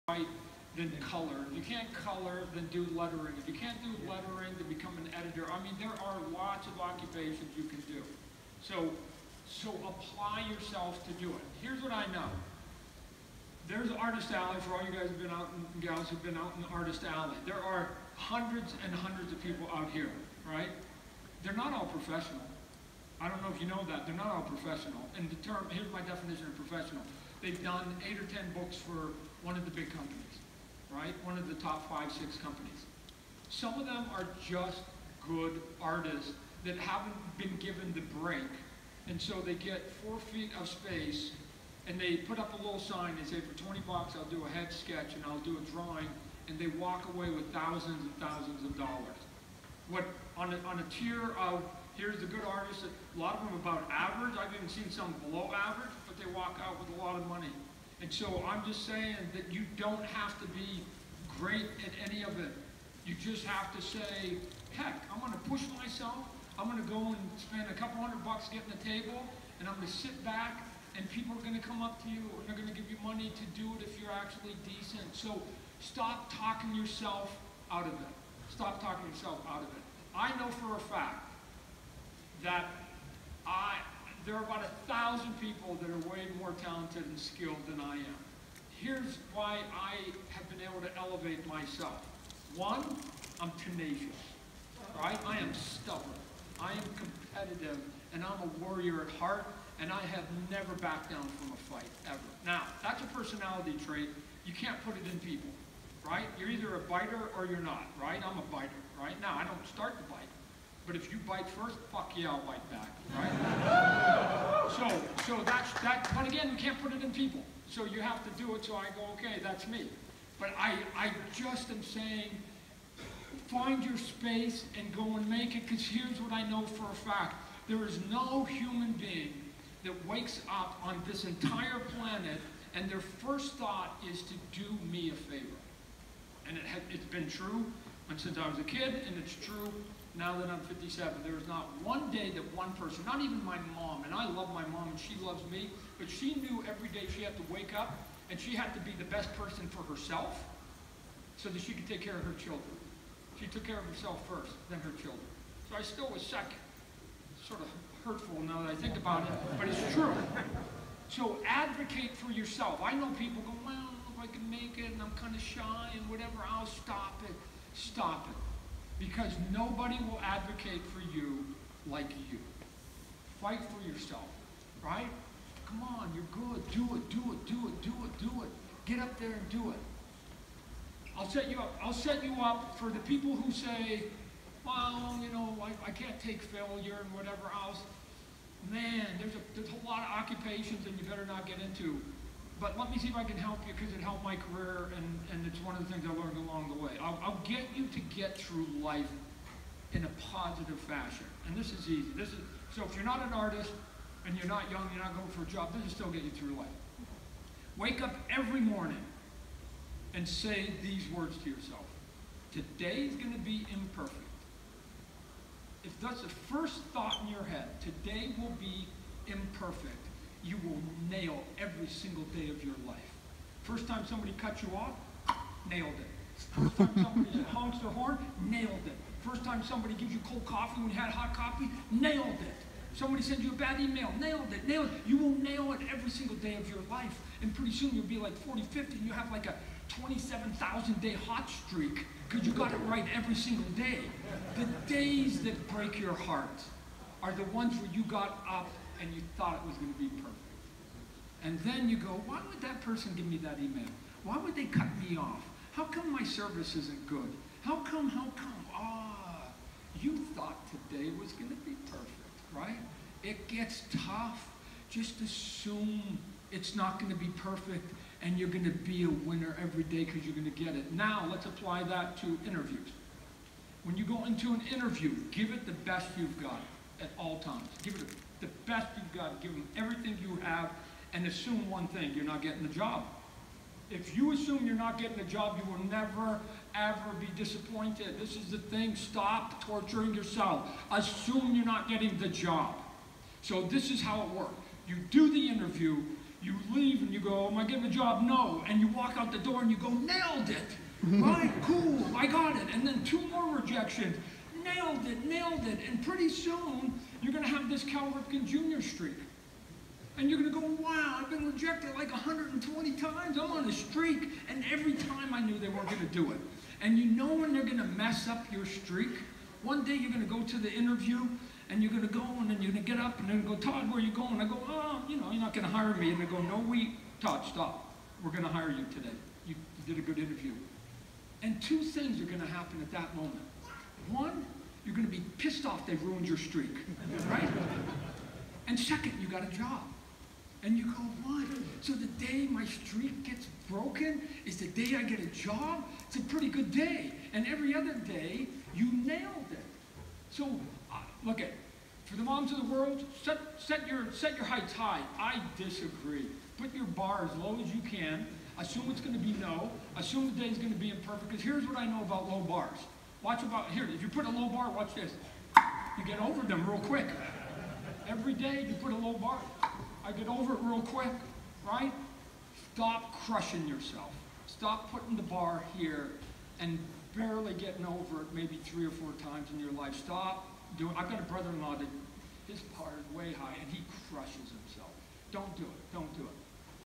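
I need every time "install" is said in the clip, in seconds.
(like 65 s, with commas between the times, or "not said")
not said.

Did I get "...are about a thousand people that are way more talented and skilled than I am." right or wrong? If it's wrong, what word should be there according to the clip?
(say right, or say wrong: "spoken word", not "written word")
right.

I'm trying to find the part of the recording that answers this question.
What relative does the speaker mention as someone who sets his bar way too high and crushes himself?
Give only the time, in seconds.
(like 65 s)
381 s.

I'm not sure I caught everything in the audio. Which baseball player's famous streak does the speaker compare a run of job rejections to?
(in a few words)
Cal Ripken Jr.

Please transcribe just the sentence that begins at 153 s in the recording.
She took care of herself first, then her children.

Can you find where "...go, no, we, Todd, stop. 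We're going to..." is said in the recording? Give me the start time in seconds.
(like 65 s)
326 s.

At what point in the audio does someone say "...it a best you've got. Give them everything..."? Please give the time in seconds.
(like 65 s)
277 s.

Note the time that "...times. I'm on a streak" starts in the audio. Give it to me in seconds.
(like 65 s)
312 s.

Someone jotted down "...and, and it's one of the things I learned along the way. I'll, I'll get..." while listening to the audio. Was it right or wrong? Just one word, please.
right.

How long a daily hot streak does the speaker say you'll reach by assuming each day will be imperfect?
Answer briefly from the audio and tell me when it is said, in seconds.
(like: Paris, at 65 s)
27,000 days, at 240 s.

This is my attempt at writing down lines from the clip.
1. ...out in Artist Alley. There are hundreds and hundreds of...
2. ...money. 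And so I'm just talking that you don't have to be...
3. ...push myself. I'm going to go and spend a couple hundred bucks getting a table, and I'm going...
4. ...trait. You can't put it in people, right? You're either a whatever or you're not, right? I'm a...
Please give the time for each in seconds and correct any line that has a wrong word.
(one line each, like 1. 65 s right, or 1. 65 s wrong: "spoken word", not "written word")
1. 16 s right
2. 57 s wrong: "saying", not "talking"
3. 65 s right
4. 103 s wrong: "biter", not "whatever".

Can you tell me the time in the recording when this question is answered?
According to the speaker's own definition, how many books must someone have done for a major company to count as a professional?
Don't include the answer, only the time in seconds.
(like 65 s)
28 s.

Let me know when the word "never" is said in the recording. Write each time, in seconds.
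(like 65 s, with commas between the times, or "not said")
100 s, 285 s.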